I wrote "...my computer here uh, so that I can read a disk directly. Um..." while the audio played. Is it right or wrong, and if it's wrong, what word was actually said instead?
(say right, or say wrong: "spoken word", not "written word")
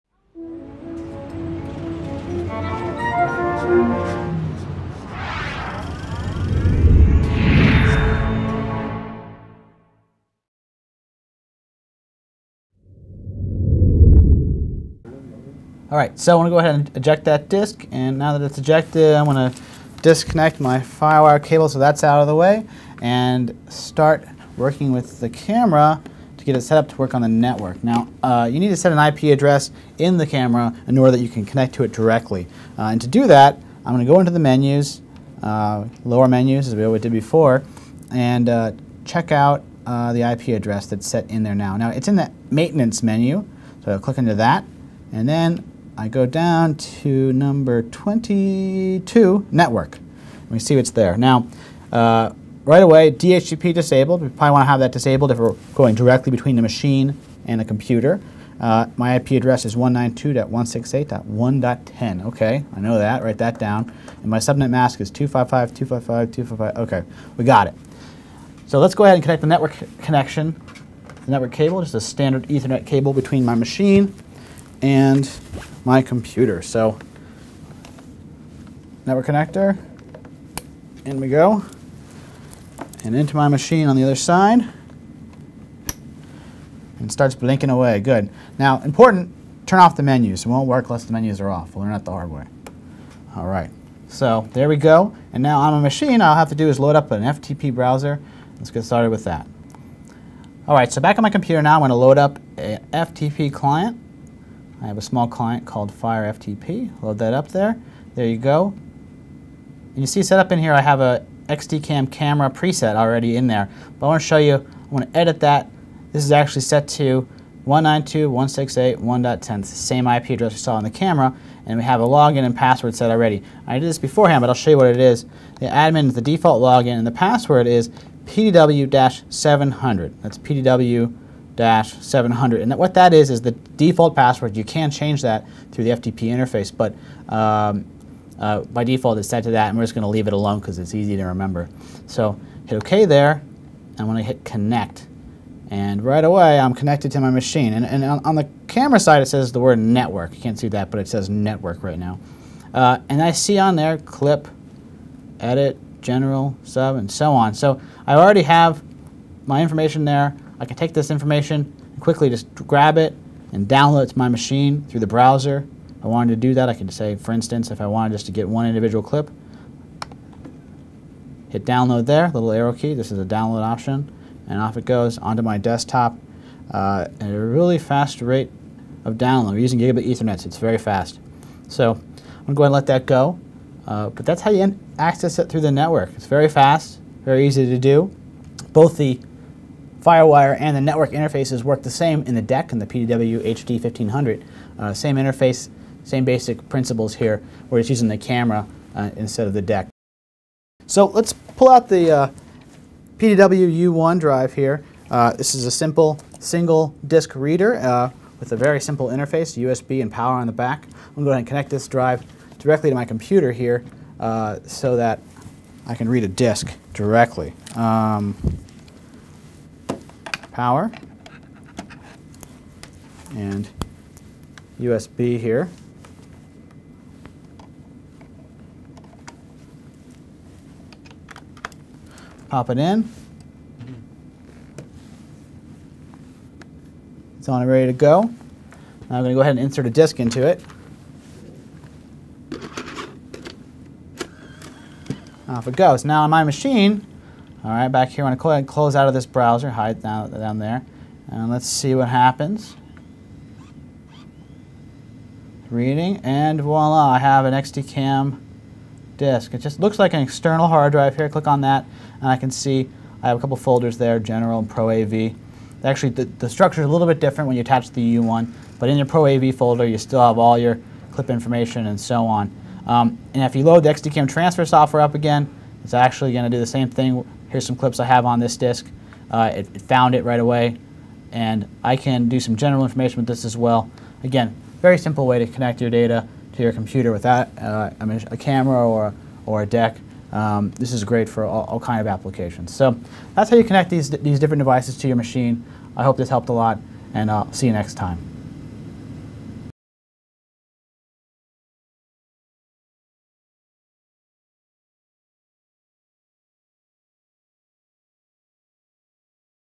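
right.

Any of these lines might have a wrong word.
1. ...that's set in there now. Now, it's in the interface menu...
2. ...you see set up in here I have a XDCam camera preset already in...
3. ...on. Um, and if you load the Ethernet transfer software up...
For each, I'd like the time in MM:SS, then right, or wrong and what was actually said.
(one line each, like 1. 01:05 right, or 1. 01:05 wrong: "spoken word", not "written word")
1. 00:40 wrong: "maintenance", not "interface"
2. 01:49 right
3. 04:32 wrong: "XDCAM", not "Ethernet".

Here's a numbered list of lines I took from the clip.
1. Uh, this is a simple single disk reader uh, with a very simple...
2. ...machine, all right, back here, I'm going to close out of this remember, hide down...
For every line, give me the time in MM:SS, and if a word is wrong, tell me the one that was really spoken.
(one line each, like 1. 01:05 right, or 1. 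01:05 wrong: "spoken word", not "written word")
1. 03:25 right
2. 04:06 wrong: "browser", not "remember".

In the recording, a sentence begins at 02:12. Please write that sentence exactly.
And that, what that is is the default password.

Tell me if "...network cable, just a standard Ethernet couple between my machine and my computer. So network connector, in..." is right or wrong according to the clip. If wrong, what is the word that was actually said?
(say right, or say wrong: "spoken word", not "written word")
wrong: "cable", not "couple".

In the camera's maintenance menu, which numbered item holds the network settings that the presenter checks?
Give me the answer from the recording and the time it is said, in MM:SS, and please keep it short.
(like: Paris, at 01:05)
22, at 00:47.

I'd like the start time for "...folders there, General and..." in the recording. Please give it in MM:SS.
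04:23.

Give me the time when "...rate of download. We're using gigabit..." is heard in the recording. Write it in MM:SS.
02:58.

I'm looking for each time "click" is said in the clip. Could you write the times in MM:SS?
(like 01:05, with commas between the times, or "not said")
00:43, 04:21.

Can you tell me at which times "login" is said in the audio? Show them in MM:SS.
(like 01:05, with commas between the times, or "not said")
02:02, 02:06.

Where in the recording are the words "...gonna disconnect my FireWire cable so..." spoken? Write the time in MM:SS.
00:19.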